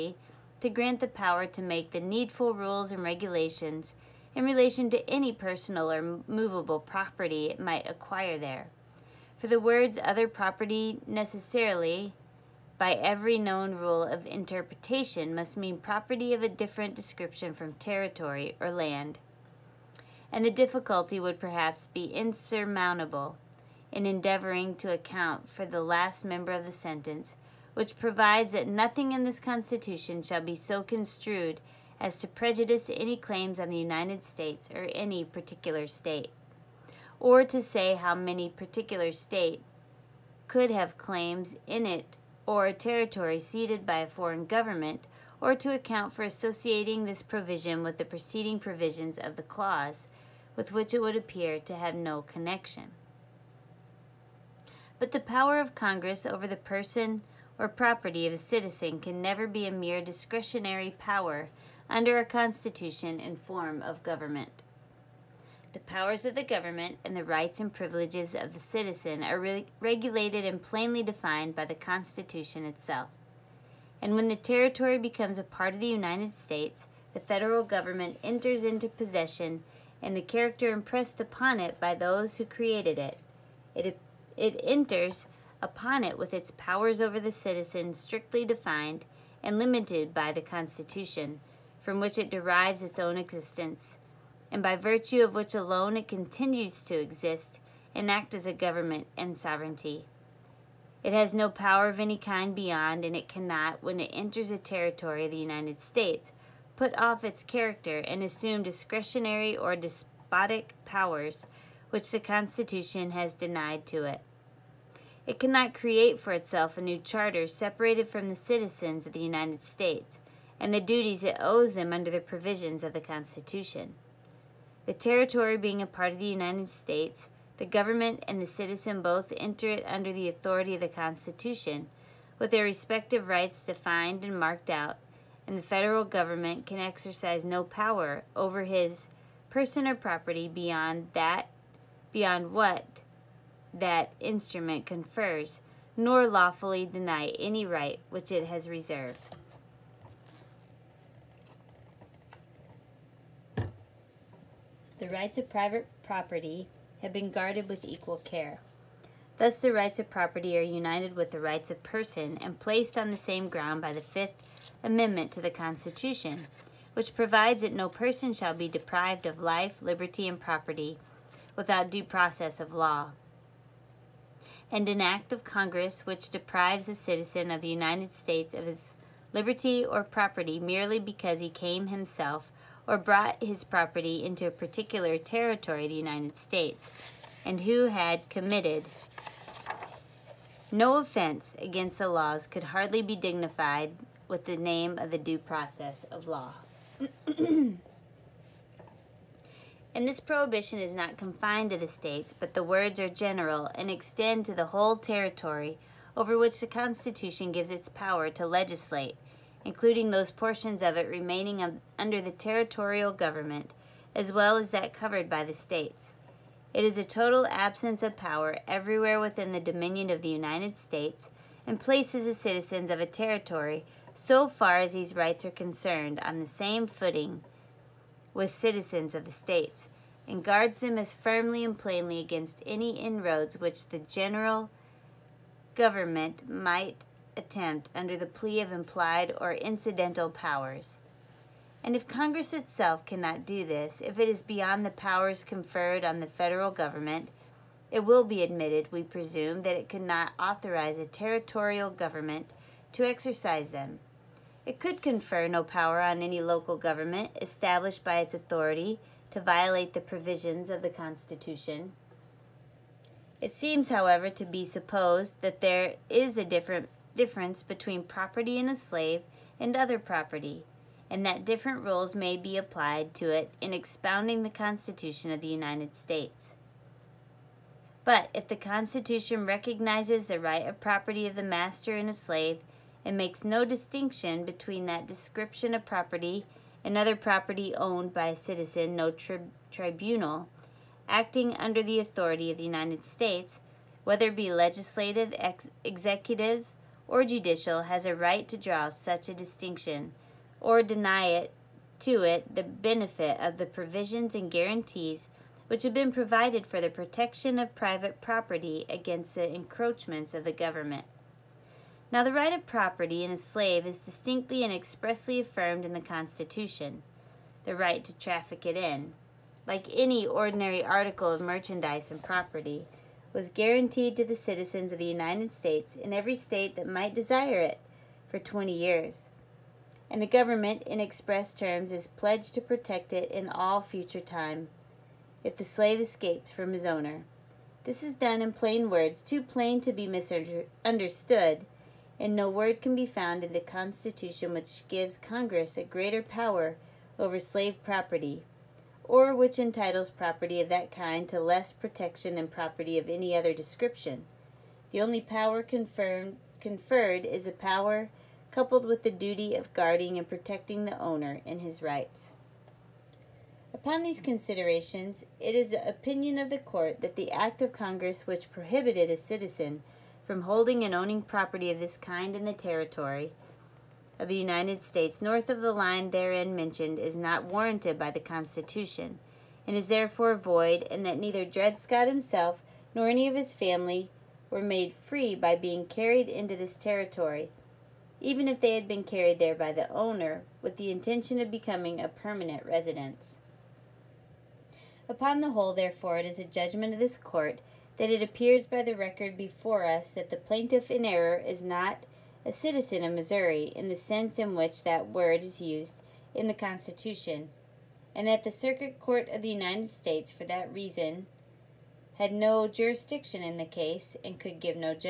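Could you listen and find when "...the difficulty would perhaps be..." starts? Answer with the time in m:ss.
0:20.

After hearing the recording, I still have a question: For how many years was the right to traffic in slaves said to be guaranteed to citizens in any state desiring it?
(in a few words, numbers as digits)
20.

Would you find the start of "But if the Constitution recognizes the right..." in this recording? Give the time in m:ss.
4:38.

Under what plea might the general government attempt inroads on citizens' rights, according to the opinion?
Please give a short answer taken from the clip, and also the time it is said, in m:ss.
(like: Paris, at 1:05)
implied or incidental powers, at 3:58.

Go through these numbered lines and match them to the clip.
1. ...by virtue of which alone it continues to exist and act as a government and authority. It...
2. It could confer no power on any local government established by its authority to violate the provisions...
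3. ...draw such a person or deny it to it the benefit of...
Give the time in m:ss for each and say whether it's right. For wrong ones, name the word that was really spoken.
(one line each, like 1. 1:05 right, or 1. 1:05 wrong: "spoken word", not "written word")
1. 1:34 wrong: "sovereignty", not "authority"
2. 4:14 right
3. 4:58 wrong: "distinction", not "person".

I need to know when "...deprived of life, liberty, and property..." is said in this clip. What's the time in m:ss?
2:48.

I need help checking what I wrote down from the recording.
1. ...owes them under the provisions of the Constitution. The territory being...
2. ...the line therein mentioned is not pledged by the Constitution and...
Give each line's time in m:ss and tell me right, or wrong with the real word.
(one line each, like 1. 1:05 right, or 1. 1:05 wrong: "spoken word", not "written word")
1. 2:01 right
2. 6:15 wrong: "warranted", not "pledged".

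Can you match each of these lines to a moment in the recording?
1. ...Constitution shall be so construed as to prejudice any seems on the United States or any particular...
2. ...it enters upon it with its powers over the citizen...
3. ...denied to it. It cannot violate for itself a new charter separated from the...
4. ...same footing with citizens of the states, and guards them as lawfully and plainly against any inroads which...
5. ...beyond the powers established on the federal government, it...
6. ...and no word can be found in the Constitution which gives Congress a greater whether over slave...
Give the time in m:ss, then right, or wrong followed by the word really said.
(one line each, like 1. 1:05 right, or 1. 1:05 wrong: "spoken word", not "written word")
1. 0:29 wrong: "claims", not "seems"
2. 1:24 right
3. 1:53 wrong: "create", not "violate"
4. 3:46 wrong: "firmly", not "lawfully"
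5. 4:04 wrong: "conferred", not "established"
6. 5:42 wrong: "power", not "whether".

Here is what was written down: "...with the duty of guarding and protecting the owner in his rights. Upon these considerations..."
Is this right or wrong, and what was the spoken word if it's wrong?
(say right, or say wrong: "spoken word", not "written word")
right.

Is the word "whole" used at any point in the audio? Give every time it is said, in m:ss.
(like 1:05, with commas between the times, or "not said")
3:24, 6:35.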